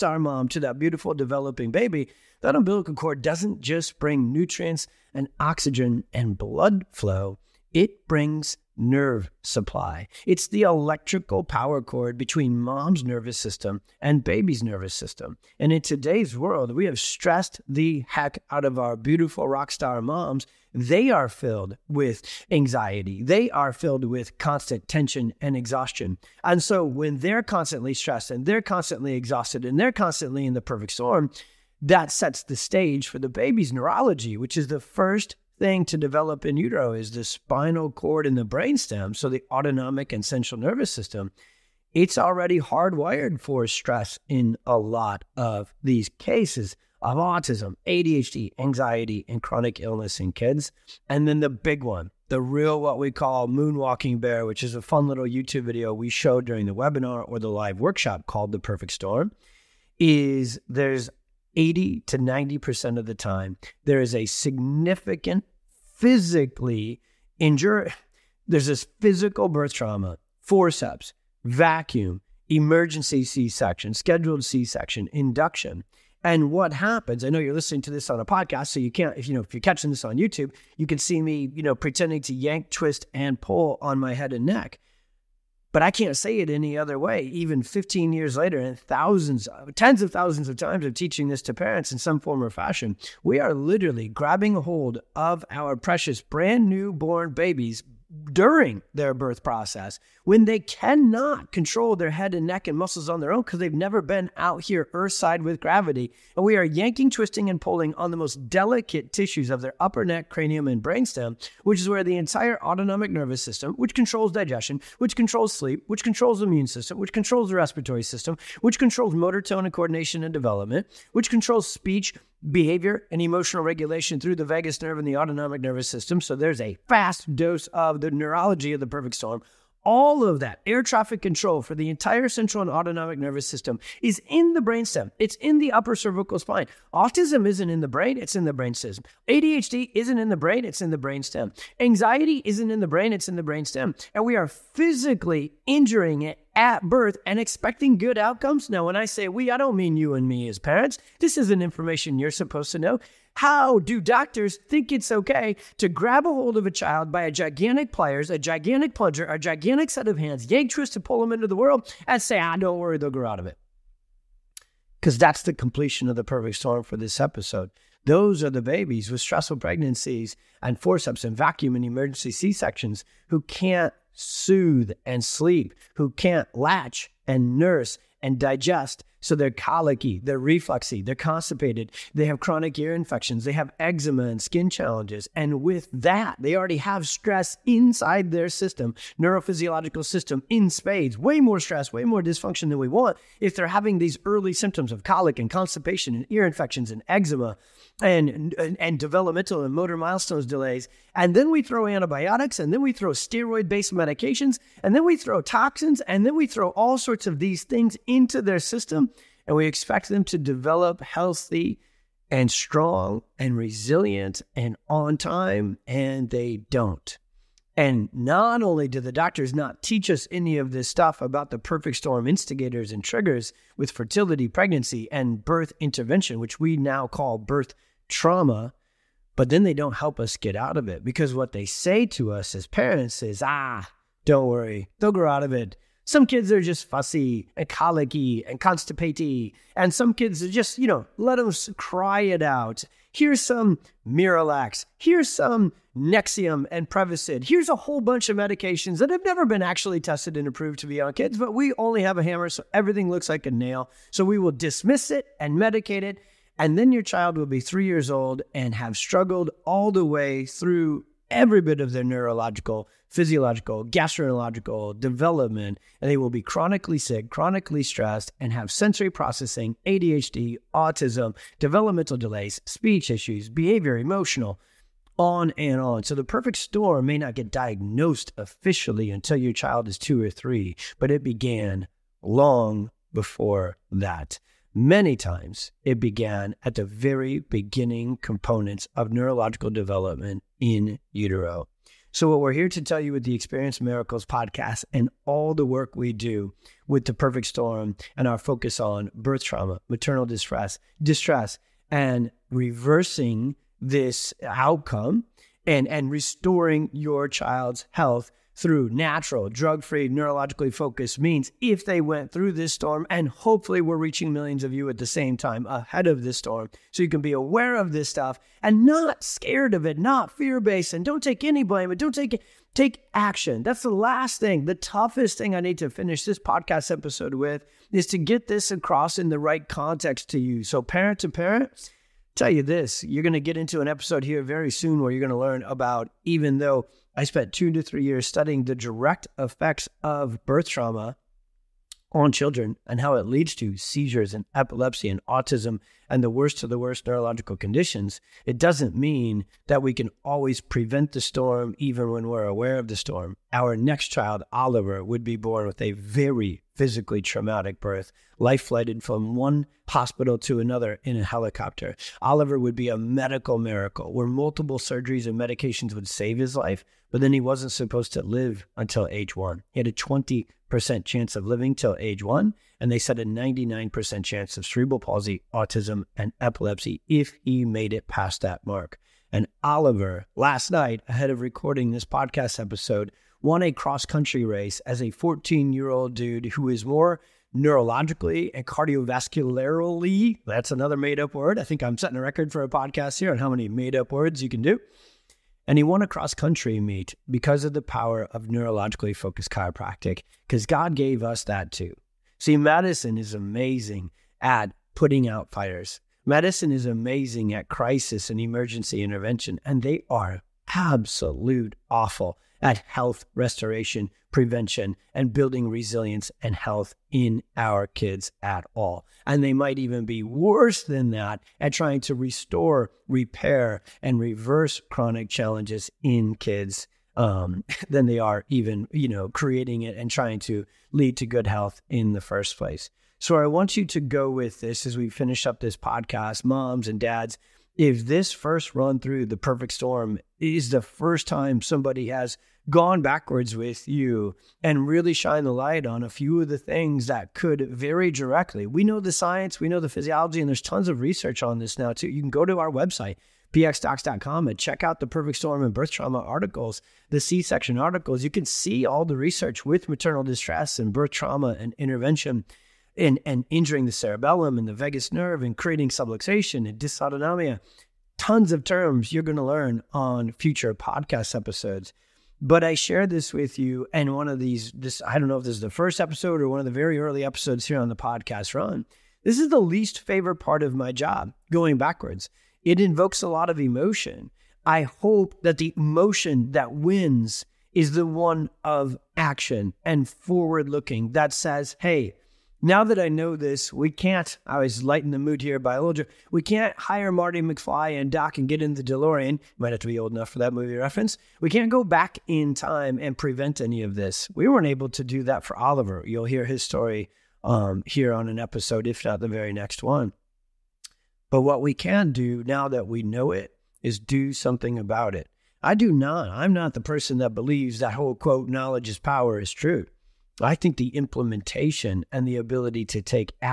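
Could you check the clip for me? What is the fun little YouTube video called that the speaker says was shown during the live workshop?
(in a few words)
moonwalking bear.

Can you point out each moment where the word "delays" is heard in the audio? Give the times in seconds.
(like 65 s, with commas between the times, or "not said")
200 s, 272 s.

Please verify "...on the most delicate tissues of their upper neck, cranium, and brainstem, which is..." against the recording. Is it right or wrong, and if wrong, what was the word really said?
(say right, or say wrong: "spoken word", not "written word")
right.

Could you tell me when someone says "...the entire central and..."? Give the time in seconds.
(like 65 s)
131 s.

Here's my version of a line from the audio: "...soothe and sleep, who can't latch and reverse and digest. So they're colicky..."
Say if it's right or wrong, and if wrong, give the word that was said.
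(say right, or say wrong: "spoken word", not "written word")
wrong: "nurse", not "reverse".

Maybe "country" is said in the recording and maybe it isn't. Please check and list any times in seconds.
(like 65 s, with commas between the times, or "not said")
384 s, 396 s.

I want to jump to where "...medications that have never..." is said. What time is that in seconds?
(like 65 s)
248 s.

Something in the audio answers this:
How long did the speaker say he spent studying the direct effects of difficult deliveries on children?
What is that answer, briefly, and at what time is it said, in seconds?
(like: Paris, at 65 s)
2 to 3 years, at 337 s.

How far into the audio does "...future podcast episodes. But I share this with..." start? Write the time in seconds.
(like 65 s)
470 s.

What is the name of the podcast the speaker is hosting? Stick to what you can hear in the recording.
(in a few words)
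Experience Miracles.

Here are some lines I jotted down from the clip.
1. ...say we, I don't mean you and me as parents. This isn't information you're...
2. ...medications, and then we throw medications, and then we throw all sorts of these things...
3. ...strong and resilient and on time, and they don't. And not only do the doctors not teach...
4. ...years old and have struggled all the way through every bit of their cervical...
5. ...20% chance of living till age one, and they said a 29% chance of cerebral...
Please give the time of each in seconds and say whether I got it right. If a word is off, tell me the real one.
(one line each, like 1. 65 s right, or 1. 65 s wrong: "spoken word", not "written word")
1. 149 s right
2. 203 s wrong: "toxins", not "medications"
3. 212 s right
4. 257 s wrong: "neurological", not "cervical"
5. 369 s wrong: "99", not "29".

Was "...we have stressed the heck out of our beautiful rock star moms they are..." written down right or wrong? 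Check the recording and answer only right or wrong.
right.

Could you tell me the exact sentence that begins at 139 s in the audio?
ADHD isn't in the brain, it's in the brainstem.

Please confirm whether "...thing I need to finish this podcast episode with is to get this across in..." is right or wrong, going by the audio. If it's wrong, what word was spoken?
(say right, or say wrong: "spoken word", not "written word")
right.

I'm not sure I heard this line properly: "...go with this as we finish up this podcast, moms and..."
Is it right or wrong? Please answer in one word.
right.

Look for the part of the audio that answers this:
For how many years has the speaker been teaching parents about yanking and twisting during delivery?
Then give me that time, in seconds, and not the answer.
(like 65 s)
87 s.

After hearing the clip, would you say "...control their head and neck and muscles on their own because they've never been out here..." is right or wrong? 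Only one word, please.
right.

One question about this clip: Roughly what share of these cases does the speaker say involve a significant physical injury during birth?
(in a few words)
80 to 90%.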